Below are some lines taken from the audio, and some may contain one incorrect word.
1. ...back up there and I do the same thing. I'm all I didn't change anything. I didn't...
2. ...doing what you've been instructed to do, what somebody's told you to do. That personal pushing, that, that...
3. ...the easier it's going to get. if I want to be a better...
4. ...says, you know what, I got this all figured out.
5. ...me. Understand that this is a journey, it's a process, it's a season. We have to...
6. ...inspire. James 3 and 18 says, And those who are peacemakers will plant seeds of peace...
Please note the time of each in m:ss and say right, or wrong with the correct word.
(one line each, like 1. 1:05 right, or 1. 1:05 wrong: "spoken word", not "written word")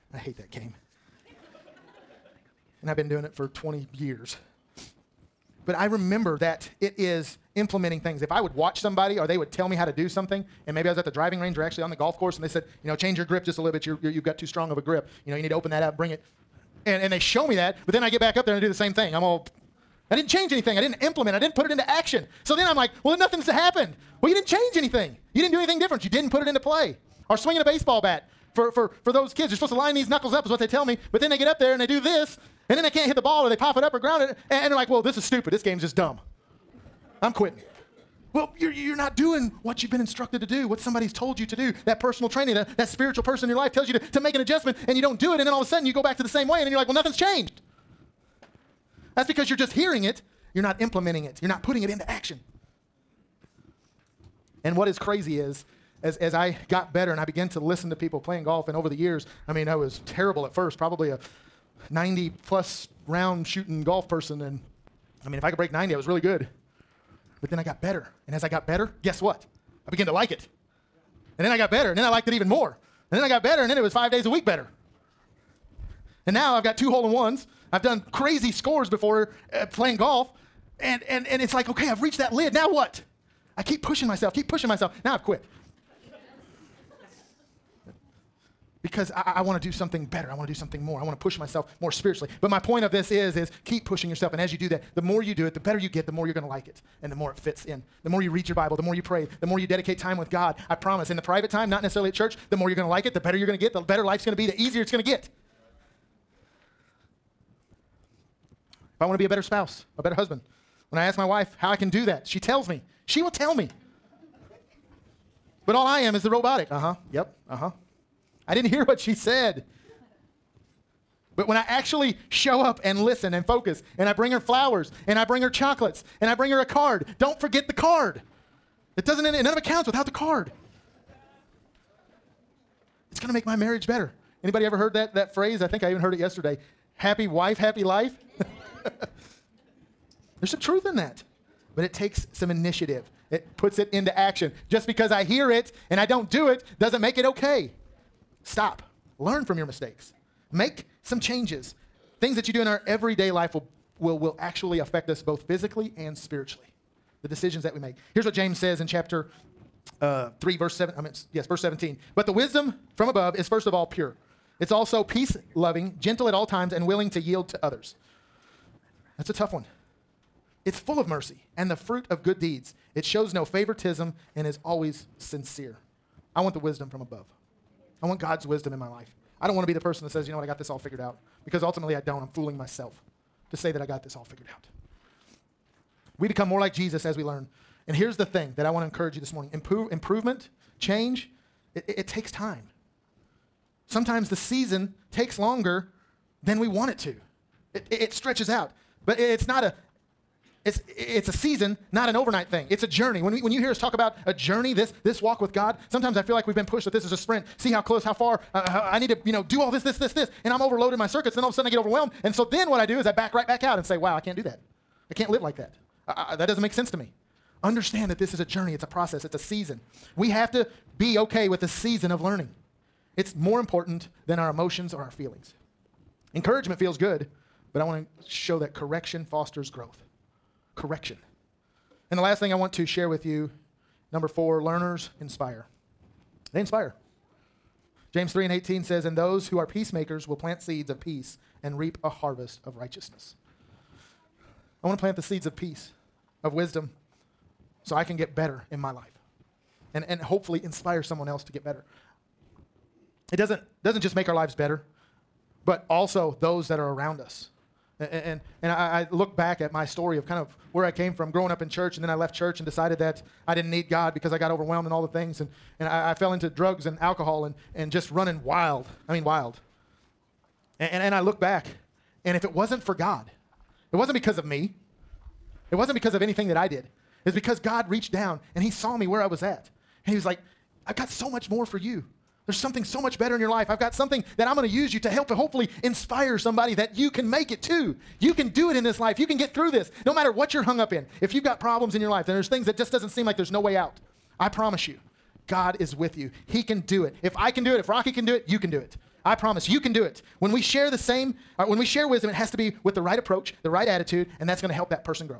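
1. 0:18 right
2. 0:39 wrong: "training", not "pushing"
3. 1:44 right
4. 3:00 right
5. 3:36 right
6. 3:56 right.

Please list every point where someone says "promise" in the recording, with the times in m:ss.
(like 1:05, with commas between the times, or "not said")
1:40, 4:54, 4:59.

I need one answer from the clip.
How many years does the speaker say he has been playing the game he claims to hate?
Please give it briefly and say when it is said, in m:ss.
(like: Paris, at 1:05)
20, at 0:03.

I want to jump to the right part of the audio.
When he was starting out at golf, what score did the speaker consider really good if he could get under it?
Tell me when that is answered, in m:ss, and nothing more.
1:05.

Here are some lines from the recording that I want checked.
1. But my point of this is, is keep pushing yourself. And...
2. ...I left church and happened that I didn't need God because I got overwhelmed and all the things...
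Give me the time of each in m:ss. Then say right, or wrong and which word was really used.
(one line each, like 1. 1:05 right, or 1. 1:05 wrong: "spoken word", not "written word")
1. 1:32 right
2. 4:22 wrong: "decided", not "happened".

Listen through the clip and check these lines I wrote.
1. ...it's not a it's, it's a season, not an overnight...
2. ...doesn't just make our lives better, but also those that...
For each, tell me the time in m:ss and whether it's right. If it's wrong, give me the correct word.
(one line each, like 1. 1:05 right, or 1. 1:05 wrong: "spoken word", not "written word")
1. 3:19 right
2. 4:13 right.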